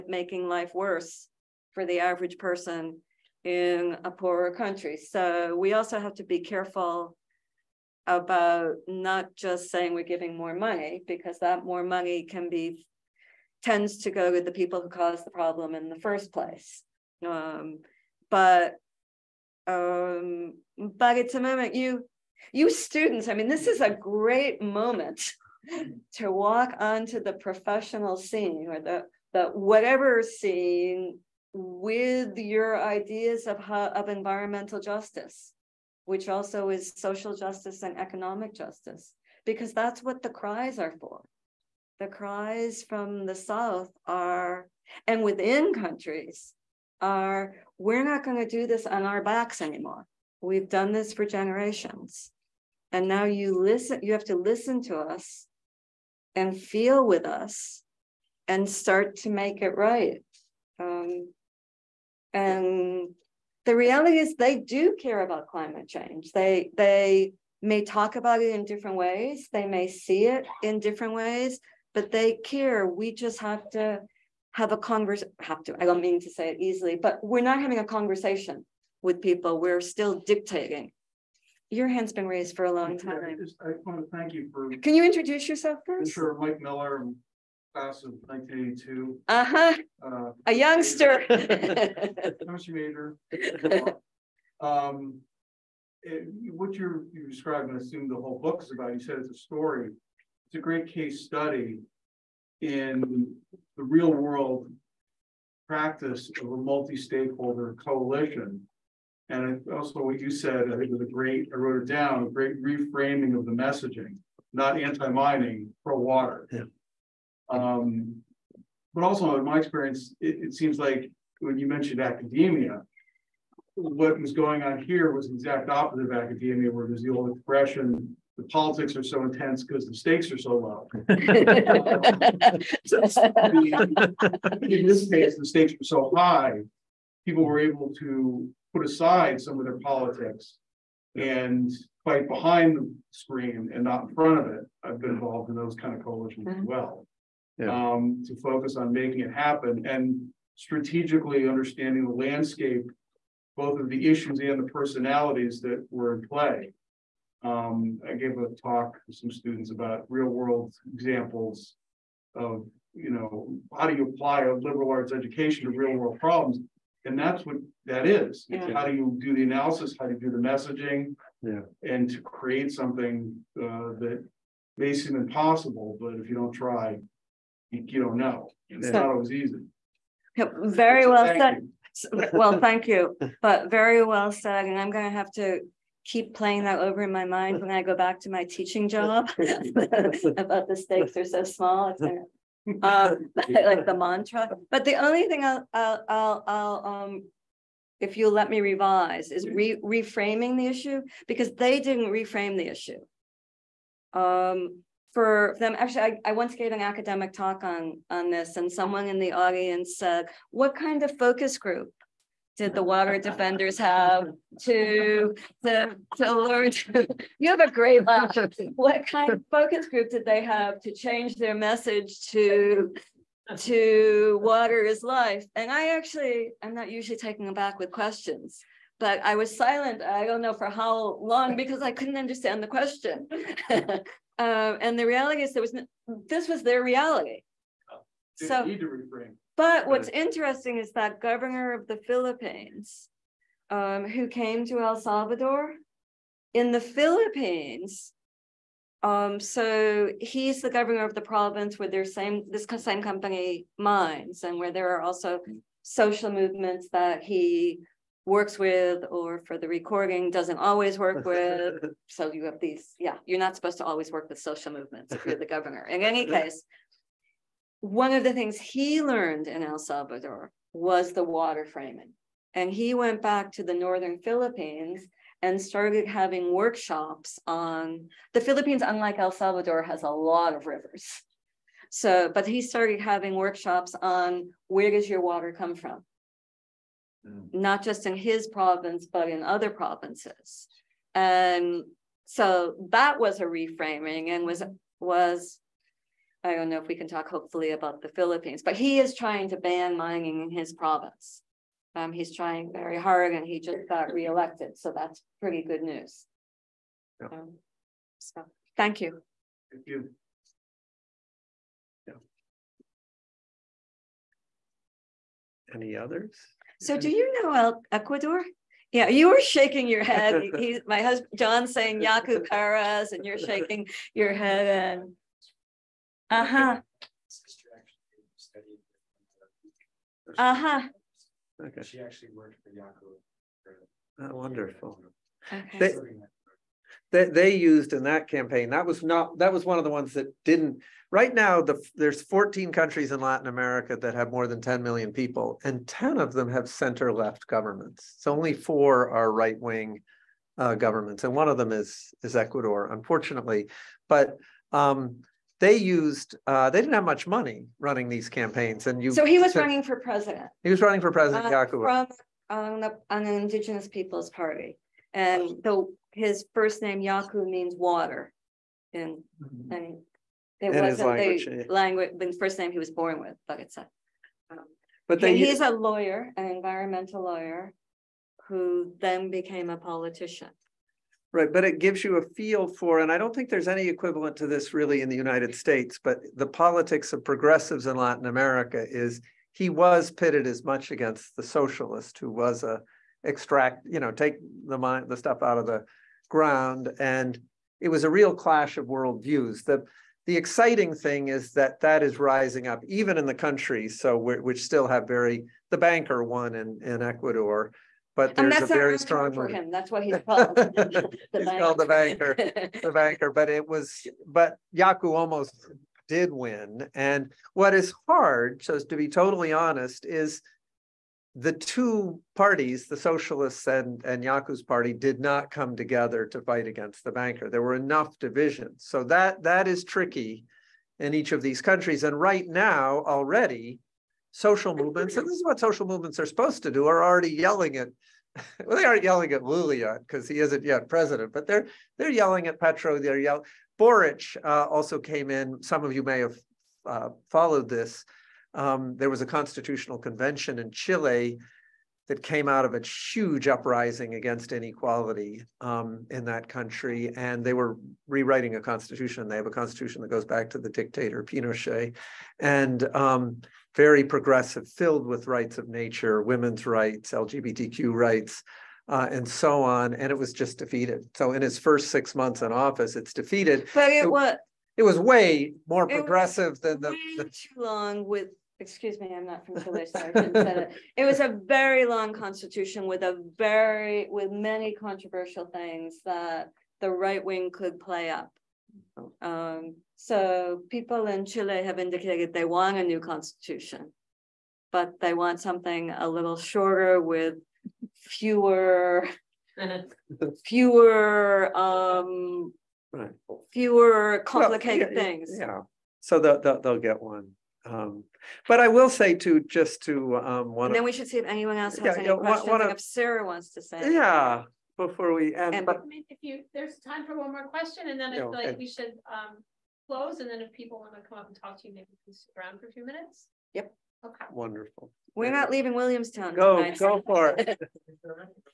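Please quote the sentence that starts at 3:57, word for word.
Oh, so, need to But what's interesting is that governor of the Philippines, um, who came to El Salvador, in the Philippines.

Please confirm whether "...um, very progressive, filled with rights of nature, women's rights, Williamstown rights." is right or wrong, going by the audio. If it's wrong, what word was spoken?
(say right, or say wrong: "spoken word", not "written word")
wrong: "LGBTQ", not "Williamstown".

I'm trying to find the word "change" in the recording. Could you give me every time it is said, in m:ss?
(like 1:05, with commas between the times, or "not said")
1:05, 3:40.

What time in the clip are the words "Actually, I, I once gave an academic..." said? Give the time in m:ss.
3:25.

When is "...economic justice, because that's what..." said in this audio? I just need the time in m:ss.
0:37.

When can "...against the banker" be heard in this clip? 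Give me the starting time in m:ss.
7:06.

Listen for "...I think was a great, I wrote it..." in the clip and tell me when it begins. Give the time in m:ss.
1:50.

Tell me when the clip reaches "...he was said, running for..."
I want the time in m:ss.
5:59.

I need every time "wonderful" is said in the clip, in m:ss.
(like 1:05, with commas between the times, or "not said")
5:34, 8:44.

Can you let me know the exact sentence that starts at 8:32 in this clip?
One, if Sarah wants to say.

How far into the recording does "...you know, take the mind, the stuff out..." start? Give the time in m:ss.
6:33.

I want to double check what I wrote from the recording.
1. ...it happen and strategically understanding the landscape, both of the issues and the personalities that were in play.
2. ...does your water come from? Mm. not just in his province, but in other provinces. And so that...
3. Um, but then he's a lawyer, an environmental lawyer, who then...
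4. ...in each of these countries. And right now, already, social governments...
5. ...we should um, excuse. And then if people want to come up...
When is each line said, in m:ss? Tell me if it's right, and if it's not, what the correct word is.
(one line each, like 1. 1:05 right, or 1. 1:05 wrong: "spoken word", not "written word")
1. 2:29 right
2. 4:44 right
3. 6:14 right
4. 7:10 wrong: "movements", not "governments"
5. 8:38 wrong: "close", not "excuse".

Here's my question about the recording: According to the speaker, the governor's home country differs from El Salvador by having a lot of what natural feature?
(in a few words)
rivers.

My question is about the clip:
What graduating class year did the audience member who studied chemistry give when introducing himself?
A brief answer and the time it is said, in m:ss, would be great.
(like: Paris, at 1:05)
1982, at 1:27.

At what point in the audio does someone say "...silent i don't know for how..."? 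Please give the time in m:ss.
3:49.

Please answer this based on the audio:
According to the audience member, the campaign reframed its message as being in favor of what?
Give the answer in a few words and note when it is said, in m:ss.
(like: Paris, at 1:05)
pro-water, at 1:55.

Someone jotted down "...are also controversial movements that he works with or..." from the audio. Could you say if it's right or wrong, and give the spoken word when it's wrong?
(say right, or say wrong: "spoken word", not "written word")
wrong: "social", not "controversial".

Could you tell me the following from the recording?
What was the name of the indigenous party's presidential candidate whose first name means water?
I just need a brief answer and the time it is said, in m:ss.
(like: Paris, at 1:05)
Yaku Perez, at 5:22.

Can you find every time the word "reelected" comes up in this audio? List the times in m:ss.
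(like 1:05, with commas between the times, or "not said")
5:04.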